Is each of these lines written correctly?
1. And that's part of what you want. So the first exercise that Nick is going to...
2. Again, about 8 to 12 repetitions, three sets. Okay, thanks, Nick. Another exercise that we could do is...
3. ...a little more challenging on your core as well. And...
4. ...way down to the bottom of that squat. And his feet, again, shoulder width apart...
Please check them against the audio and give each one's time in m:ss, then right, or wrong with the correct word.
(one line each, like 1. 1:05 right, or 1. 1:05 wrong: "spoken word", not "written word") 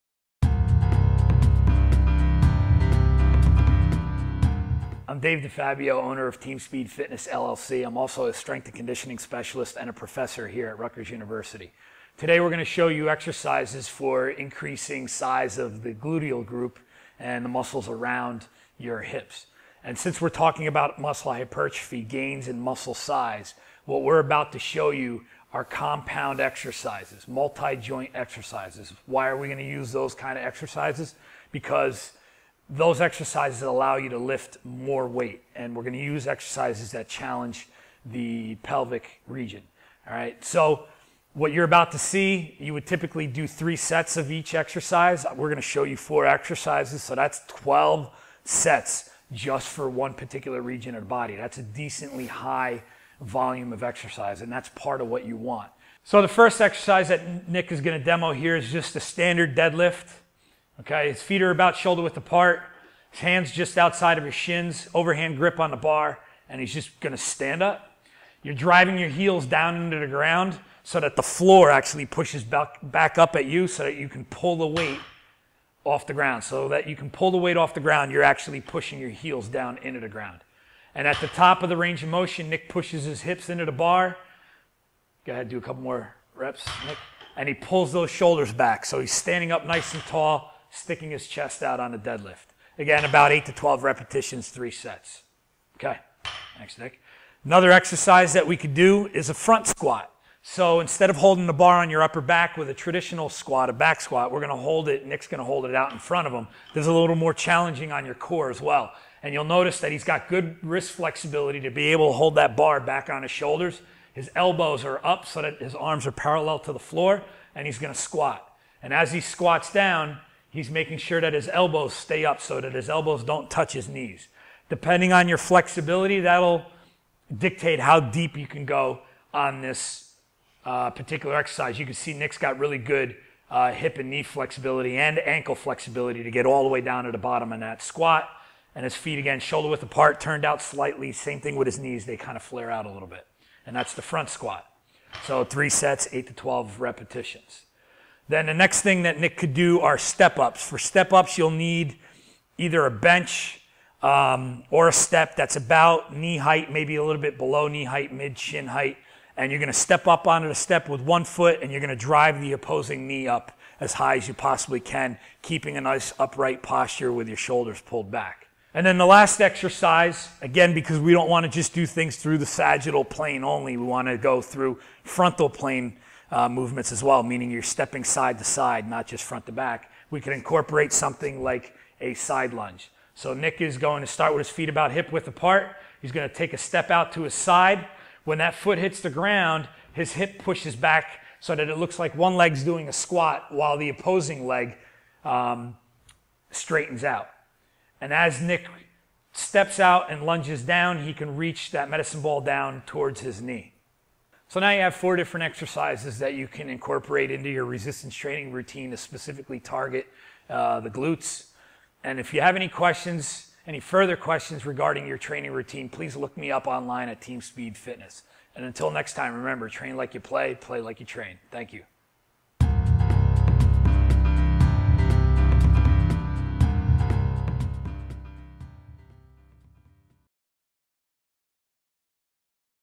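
1. 0:54 right
2. 1:32 right
3. 1:46 right
4. 2:16 right.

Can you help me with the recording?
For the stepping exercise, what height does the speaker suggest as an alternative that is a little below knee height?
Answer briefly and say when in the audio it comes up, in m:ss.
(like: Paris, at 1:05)
mid shin height, at 2:38.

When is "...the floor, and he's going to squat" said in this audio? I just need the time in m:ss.
1:56.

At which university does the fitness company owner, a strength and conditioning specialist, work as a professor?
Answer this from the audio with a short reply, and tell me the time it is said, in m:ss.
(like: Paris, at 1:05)
Rutgers University, at 0:10.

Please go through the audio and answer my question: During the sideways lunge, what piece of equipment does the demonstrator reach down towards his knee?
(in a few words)
medicine ball.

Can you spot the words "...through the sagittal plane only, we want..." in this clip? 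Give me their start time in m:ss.
2:52.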